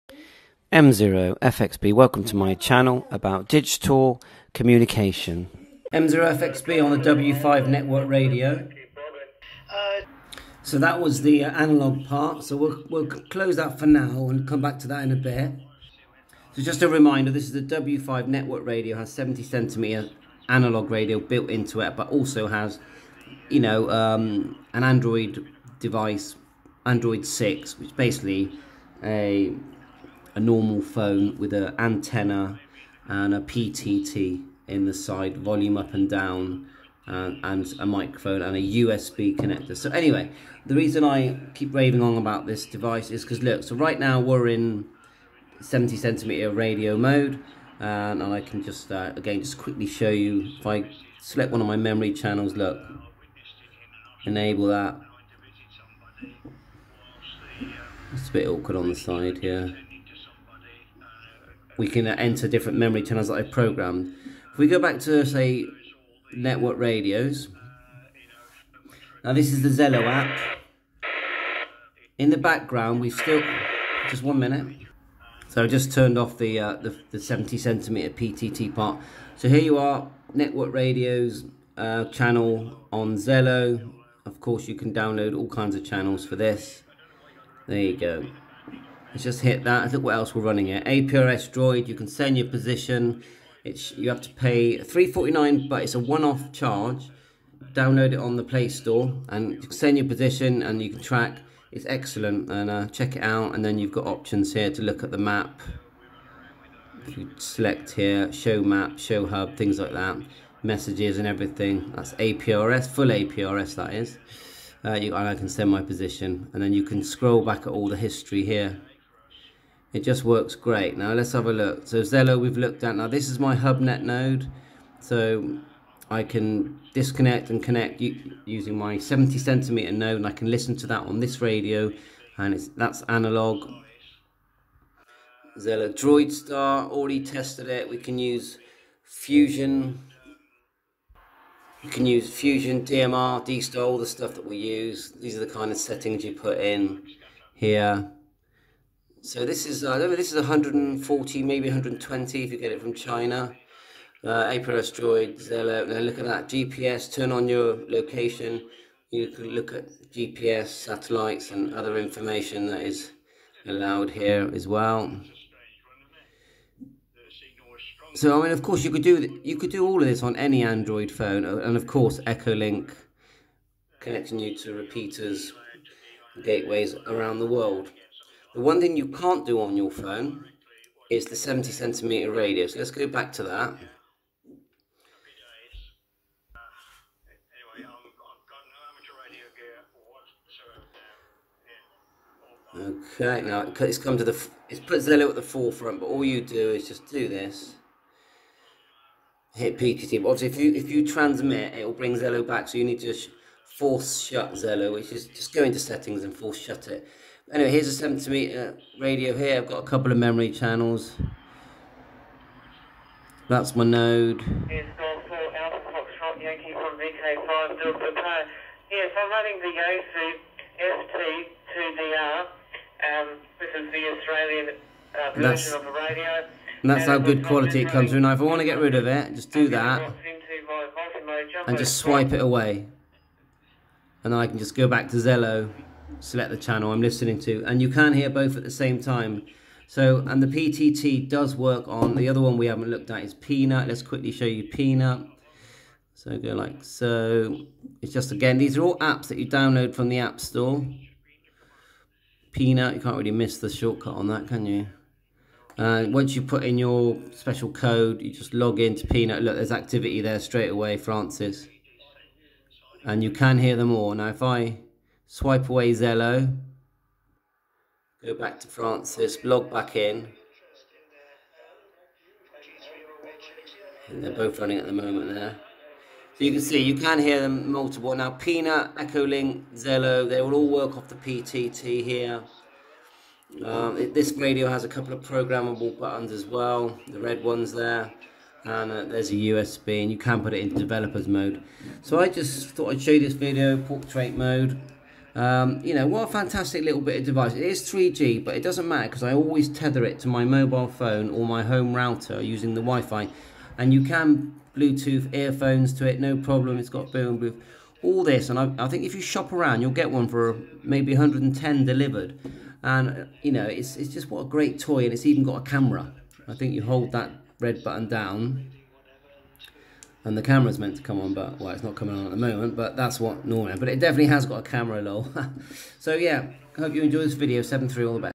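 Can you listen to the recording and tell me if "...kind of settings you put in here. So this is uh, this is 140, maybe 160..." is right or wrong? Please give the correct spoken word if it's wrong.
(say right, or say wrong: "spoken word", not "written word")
wrong: "120", not "160".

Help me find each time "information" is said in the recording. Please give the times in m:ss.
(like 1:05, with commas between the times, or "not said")
2:41.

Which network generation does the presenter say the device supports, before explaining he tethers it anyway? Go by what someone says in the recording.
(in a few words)
3G.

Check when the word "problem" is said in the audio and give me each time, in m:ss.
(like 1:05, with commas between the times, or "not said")
5:06.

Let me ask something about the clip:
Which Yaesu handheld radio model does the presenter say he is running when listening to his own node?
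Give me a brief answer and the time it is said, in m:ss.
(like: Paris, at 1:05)
FT2DR, at 3:40.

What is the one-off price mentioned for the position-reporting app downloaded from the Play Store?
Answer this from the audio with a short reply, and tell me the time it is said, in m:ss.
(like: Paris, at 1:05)
349, at 1:34.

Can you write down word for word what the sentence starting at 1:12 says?
In the background, we've still, just one minute.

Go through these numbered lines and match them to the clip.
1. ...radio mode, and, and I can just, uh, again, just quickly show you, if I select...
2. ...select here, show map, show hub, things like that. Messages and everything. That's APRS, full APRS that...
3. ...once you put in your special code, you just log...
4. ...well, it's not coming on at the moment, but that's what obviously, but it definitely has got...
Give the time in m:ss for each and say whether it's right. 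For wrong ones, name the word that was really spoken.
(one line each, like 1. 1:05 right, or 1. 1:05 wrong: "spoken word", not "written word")
1. 0:46 right
2. 1:47 right
3. 4:16 right
4. 5:21 wrong: "normally", not "obviously".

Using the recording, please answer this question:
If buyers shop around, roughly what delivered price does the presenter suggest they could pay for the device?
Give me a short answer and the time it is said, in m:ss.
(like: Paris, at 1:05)
110, at 5:11.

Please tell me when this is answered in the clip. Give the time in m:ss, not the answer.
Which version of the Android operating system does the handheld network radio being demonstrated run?
0:26.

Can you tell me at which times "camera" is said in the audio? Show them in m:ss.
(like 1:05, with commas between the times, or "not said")
5:15, 5:20, 5:24.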